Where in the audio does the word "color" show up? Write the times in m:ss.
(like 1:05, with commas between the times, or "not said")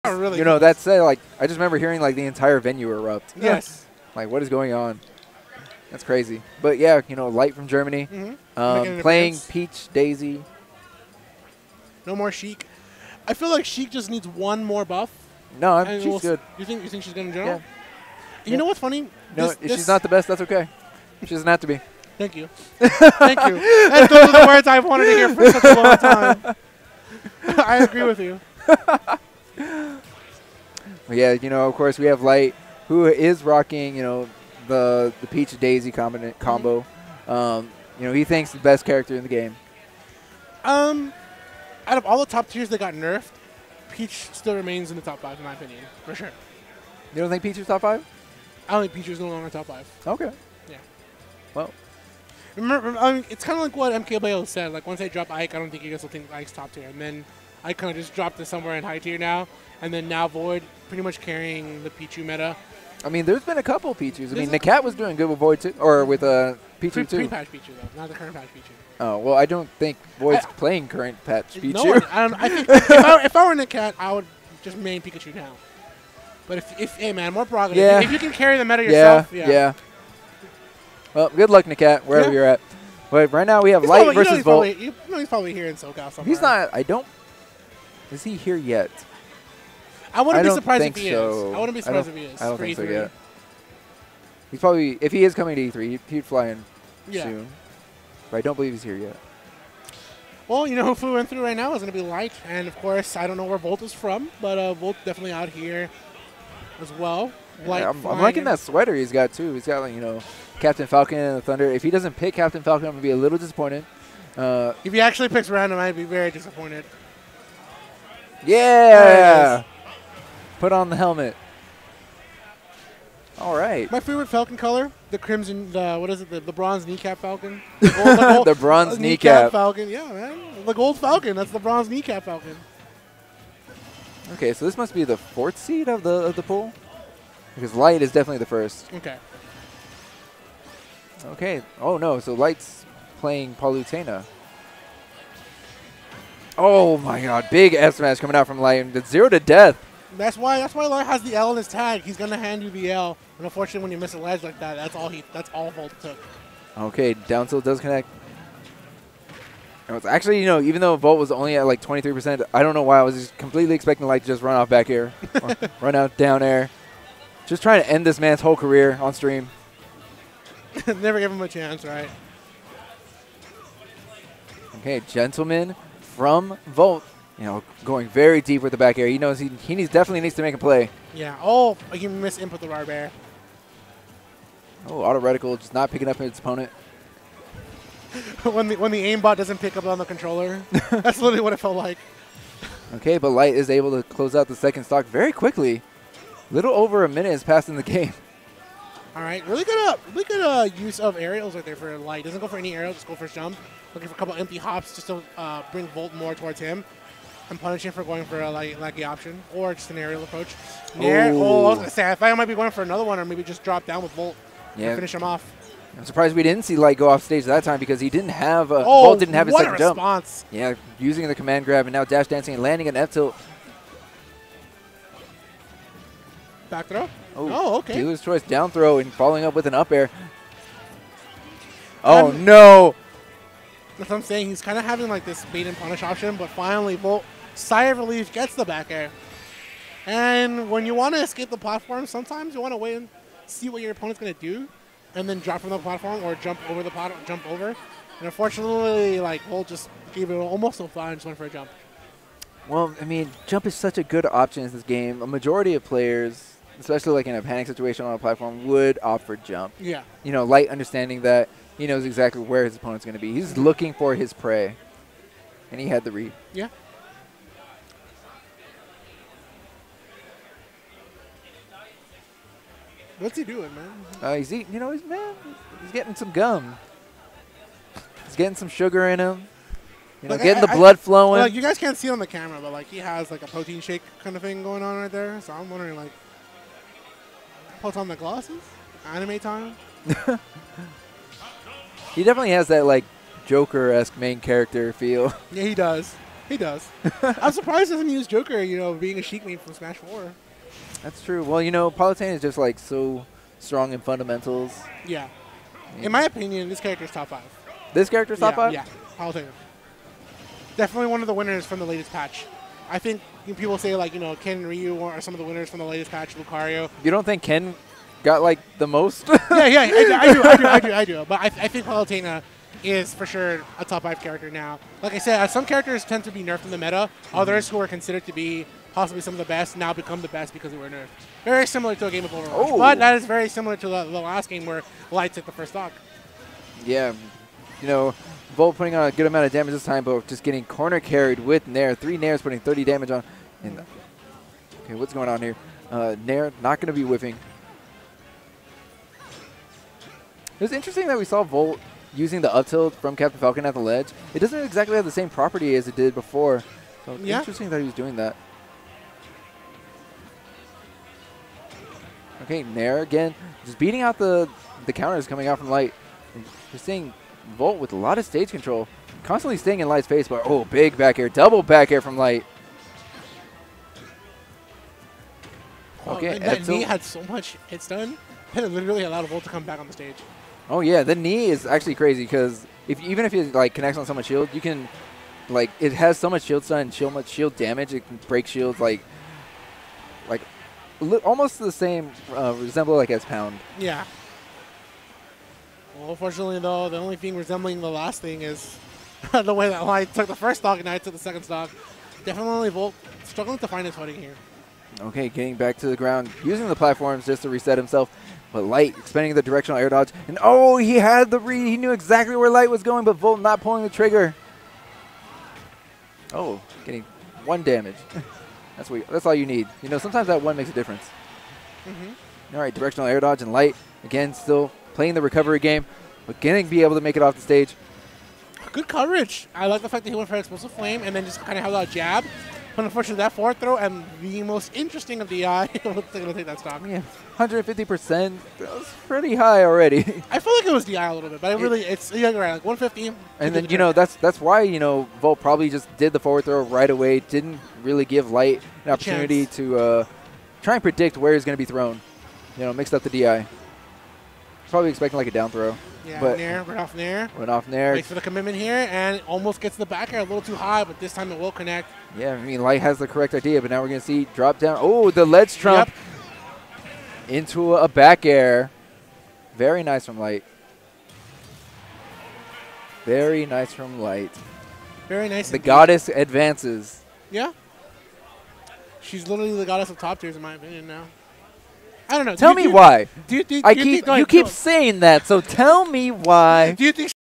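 2:04.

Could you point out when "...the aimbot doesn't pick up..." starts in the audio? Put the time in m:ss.
3:08.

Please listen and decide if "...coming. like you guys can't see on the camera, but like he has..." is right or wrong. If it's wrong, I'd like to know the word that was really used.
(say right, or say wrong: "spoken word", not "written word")
wrong: "flowing", not "coming".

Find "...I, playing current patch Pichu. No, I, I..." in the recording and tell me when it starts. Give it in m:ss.
1:10.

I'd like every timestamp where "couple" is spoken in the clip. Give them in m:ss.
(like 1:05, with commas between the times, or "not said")
1:03, 3:24.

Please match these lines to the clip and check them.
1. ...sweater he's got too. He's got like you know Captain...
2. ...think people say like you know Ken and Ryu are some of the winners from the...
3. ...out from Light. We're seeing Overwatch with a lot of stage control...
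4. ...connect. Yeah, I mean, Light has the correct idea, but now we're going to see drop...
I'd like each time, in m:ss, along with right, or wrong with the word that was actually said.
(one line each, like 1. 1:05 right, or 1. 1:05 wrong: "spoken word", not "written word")
1. 1:48 right
2. 5:12 right
3. 6:05 wrong: "Volt", not "Overwatch"
4. 7:41 right.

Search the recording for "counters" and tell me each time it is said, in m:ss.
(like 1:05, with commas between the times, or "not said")
6:04.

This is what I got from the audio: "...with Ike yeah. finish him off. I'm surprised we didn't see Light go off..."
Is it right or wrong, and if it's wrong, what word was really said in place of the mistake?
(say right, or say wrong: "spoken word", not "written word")
wrong: "Volt", not "Ike".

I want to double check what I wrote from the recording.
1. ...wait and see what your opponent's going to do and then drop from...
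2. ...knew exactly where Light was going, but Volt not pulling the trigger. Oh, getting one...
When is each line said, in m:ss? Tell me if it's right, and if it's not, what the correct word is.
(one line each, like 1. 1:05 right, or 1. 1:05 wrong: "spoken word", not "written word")
1. 4:02 right
2. 6:51 right.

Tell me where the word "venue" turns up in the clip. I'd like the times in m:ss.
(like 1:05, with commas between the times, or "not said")
0:02.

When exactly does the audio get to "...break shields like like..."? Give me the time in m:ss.
6:28.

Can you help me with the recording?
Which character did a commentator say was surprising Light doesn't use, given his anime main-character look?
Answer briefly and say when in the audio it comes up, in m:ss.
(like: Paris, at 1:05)
Joker, at 4:58.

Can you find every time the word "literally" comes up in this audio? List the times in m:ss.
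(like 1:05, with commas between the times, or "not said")
3:11, 6:18, 7:59.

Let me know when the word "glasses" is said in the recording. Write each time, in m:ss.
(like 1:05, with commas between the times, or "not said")
4:48.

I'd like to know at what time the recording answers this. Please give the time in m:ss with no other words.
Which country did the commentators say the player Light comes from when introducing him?
0:07.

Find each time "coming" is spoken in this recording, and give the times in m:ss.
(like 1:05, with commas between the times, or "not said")
1:35, 2:28, 6:05.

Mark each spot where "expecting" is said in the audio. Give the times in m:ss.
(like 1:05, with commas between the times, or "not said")
2:43, 7:34.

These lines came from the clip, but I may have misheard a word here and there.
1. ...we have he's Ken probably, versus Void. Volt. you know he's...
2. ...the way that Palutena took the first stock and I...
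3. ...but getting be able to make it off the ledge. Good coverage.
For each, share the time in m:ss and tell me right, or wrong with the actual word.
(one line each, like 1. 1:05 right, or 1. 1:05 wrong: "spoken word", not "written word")
1. 1:23 wrong: "Light", not "Ken"
2. 6:39 wrong: "Light", not "Palutena"
3. 7:06 wrong: "stage", not "ledge".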